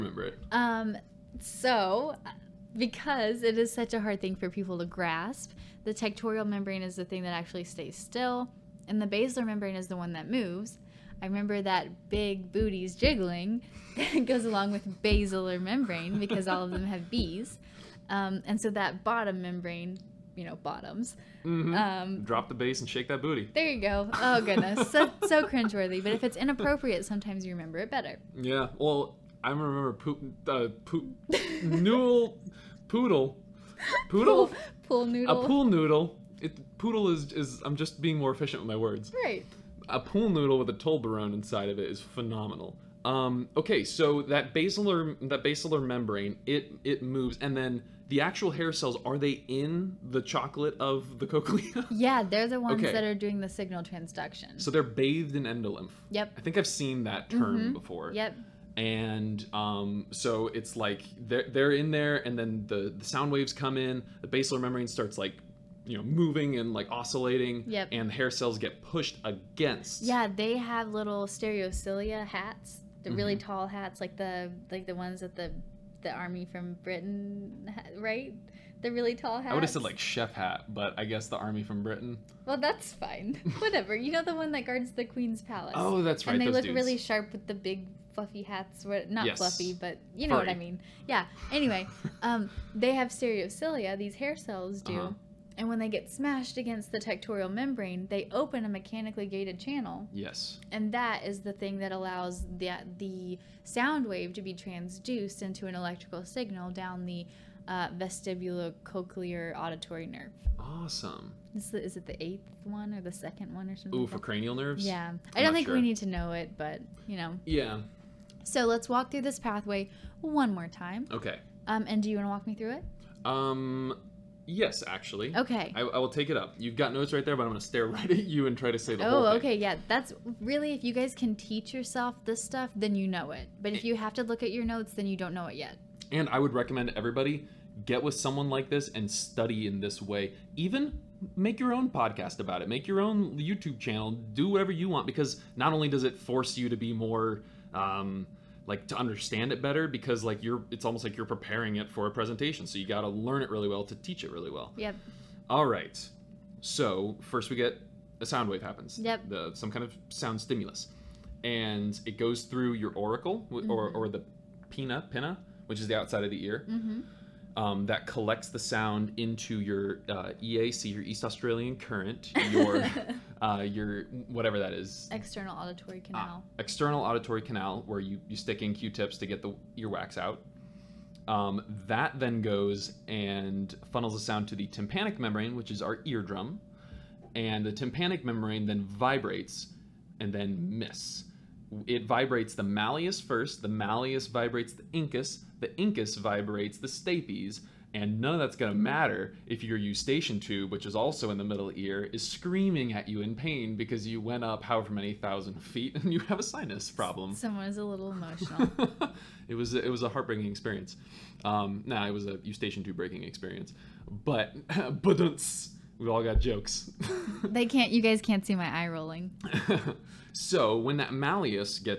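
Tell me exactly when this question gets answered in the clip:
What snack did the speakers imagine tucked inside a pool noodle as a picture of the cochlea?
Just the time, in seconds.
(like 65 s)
40 s.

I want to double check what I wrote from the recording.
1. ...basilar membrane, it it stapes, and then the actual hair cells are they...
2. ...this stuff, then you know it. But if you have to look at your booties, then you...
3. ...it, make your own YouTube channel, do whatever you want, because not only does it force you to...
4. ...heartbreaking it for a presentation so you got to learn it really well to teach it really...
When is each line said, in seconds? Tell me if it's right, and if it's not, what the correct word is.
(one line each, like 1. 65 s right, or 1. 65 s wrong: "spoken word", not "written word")
1. 45 s wrong: "moves", not "stapes"
2. 132 s wrong: "notes", not "booties"
3. 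142 s right
4. 151 s wrong: "preparing", not "heartbreaking".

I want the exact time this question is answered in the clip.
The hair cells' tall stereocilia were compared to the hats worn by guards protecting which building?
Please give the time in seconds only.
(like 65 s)
85 s.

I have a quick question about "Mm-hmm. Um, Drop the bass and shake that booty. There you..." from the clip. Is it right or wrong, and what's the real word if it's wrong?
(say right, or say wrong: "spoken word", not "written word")
right.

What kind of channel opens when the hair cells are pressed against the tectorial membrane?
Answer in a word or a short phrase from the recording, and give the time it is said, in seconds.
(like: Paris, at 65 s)
mechanically gated channel, at 98 s.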